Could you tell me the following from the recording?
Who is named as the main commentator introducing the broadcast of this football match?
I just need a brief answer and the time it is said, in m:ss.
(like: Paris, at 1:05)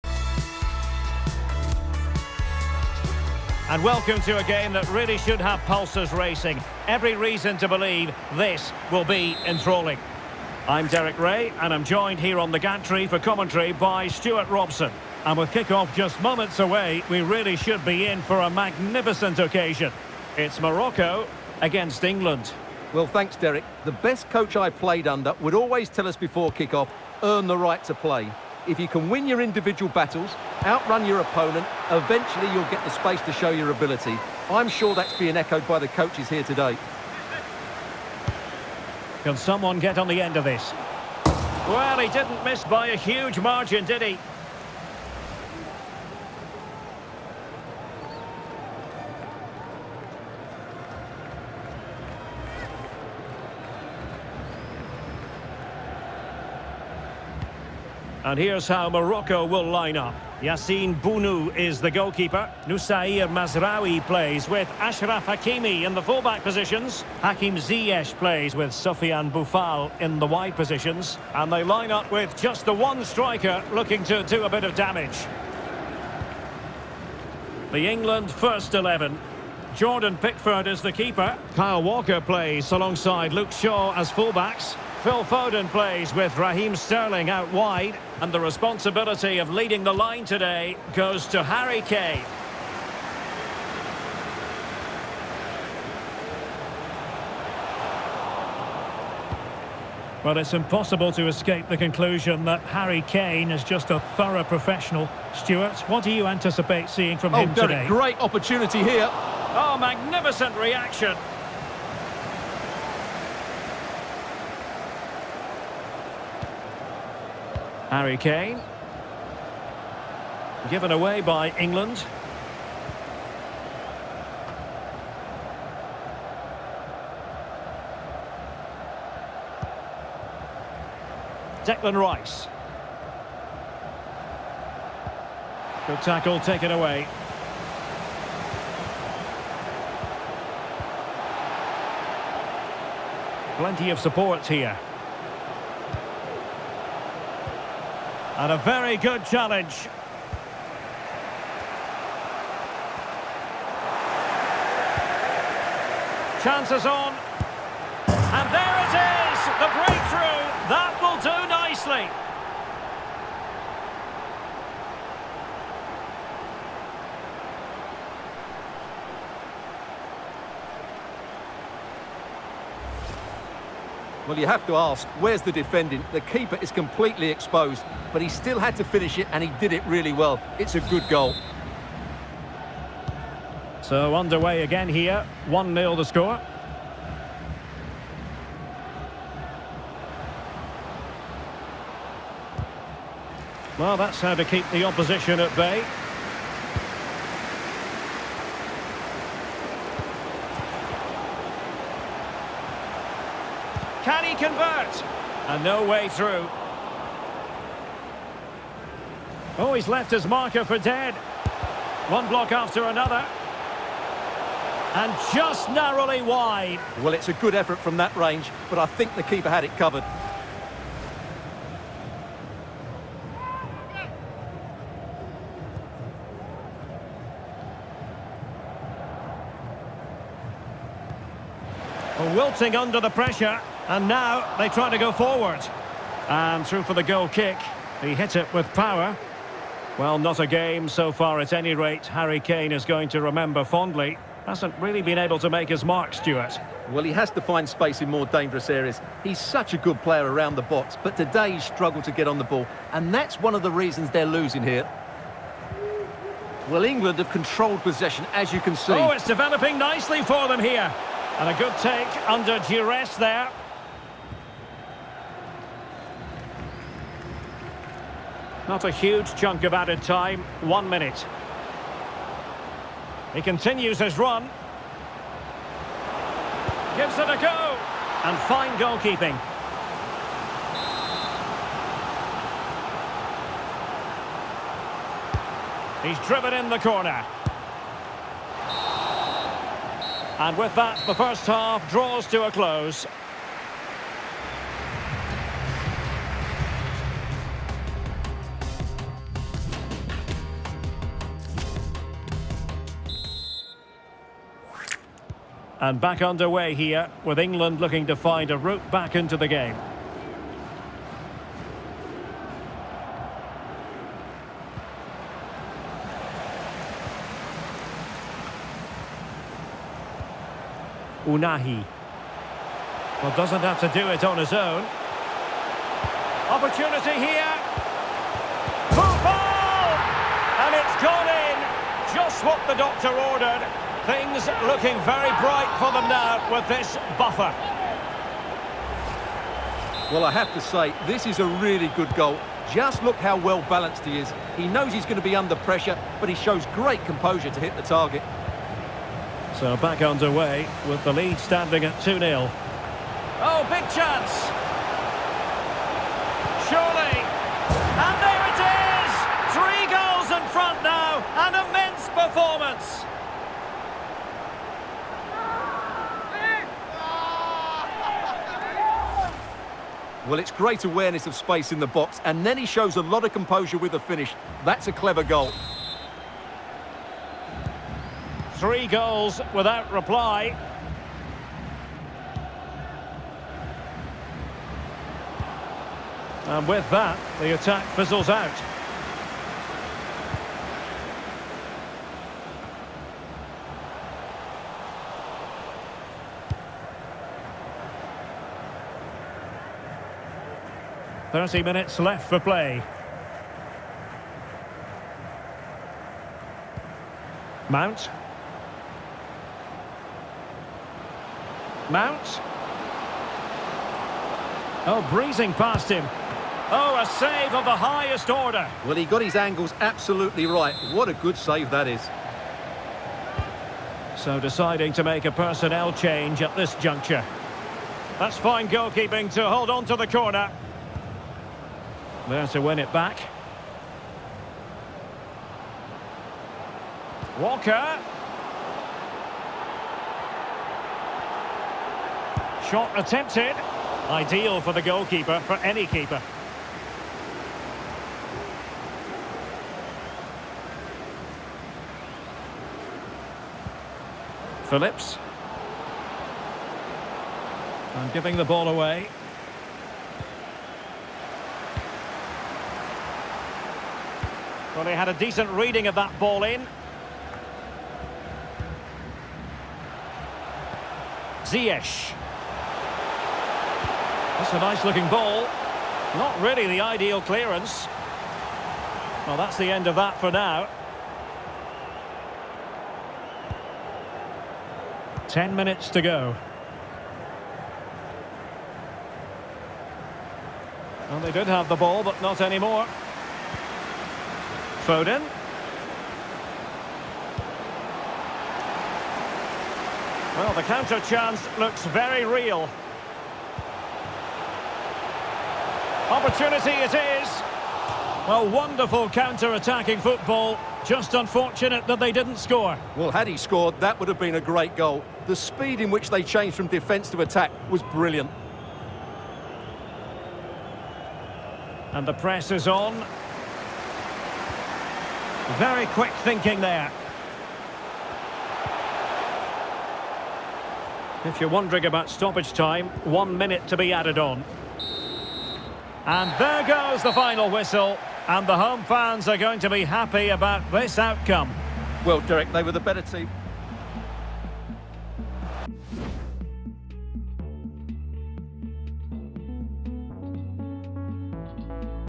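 Derek Ray, at 0:10.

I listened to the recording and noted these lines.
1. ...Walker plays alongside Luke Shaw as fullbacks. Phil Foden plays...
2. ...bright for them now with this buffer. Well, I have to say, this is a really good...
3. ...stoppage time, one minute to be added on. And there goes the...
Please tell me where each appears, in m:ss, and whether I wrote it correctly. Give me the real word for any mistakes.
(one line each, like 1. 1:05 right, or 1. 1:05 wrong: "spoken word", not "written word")
1. 1:21 right
2. 5:35 right
3. 8:52 right.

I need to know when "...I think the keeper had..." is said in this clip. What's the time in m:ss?
3:38.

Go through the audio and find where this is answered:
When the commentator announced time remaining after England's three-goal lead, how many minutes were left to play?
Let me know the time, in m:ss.
6:41.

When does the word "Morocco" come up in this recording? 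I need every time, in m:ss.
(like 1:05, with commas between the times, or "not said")
0:20, 0:58.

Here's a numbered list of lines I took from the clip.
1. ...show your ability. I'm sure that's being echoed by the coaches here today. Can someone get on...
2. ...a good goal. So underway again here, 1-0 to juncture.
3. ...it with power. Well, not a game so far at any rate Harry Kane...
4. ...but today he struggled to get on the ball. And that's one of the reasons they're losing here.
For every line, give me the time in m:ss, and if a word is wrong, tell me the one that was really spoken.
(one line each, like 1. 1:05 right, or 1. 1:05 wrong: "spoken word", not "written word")
1. 0:33 right
2. 3:00 wrong: "score", not "juncture"
3. 3:58 right
4. 4:11 right.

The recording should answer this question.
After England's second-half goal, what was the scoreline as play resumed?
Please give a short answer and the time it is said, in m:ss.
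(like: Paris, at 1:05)
2-0, at 5:52.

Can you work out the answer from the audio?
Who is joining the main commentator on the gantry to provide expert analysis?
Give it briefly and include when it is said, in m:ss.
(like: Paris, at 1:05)
Stuart Robson, at 0:14.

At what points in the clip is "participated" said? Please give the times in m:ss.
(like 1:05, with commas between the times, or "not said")
not said.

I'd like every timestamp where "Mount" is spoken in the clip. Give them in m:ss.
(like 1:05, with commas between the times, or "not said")
6:47, 6:51.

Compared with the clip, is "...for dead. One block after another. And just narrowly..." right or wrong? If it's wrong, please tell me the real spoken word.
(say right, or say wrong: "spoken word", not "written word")
right.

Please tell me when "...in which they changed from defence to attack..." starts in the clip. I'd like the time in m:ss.
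8:35.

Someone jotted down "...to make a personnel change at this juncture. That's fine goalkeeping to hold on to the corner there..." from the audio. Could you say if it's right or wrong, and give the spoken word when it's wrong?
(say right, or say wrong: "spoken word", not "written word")
right.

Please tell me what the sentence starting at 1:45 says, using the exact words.
Stuart, what do you anticipate seeing from oh, him today?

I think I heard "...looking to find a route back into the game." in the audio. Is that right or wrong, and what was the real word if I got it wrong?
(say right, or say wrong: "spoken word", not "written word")
right.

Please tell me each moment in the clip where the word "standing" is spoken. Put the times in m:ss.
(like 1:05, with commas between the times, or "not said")
5:51.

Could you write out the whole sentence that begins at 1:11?
And they line up with just the one striker looking to do a bit of damage.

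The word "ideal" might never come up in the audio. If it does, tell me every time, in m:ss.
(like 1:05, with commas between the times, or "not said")
7:24, 7:56.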